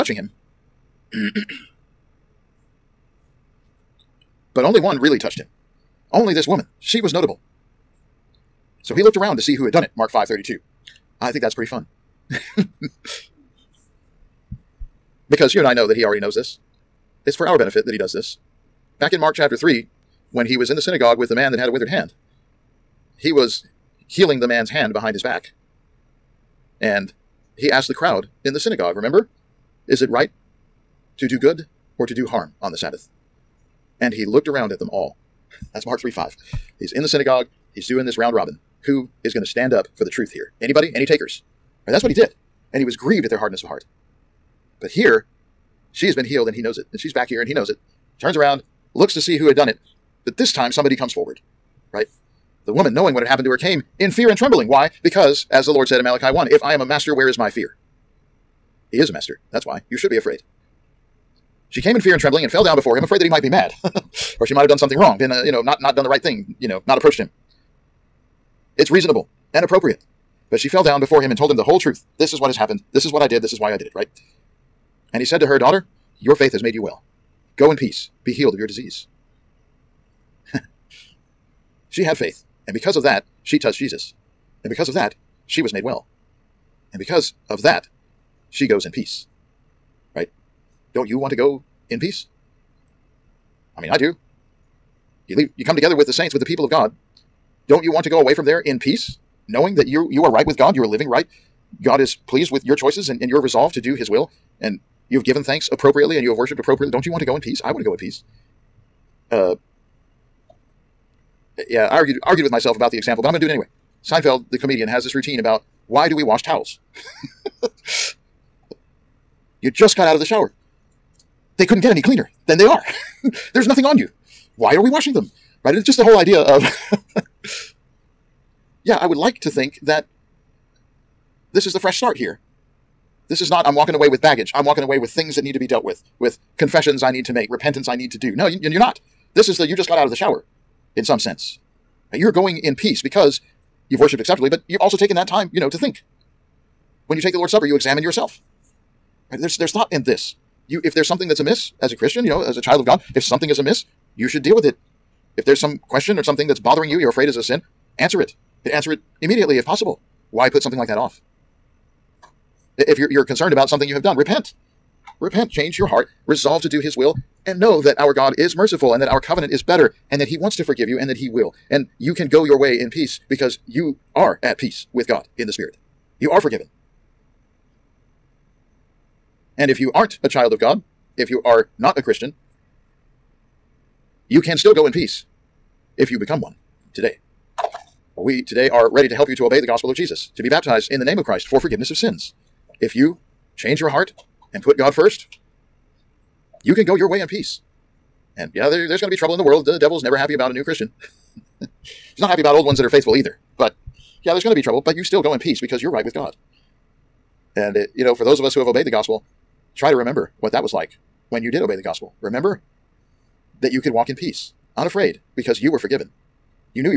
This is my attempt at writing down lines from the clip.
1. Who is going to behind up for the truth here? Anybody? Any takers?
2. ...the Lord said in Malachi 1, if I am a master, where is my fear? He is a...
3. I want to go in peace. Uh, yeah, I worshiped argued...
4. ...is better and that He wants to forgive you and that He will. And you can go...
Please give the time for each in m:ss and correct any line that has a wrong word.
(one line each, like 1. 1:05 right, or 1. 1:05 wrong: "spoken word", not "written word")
1. 0:38 wrong: "stand", not "behind"
2. 0:55 right
3. 1:47 wrong: "argued", not "worshiped"
4. 2:49 right.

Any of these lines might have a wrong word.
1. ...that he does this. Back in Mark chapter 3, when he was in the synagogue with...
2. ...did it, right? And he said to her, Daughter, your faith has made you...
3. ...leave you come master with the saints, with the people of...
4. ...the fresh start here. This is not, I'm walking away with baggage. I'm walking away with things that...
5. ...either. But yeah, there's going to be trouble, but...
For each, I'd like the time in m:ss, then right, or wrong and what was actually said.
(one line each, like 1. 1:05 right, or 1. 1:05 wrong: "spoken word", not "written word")
1. 0:17 right
2. 1:13 right
3. 1:35 wrong: "together", not "master"
4. 2:11 right
5. 3:23 right.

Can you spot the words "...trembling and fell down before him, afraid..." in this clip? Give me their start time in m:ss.
1:02.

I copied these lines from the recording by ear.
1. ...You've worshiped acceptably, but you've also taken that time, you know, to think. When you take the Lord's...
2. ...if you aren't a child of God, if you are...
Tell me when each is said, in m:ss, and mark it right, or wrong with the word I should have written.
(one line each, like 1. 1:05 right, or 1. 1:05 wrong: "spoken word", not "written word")
1. 2:23 right
2. 2:59 right.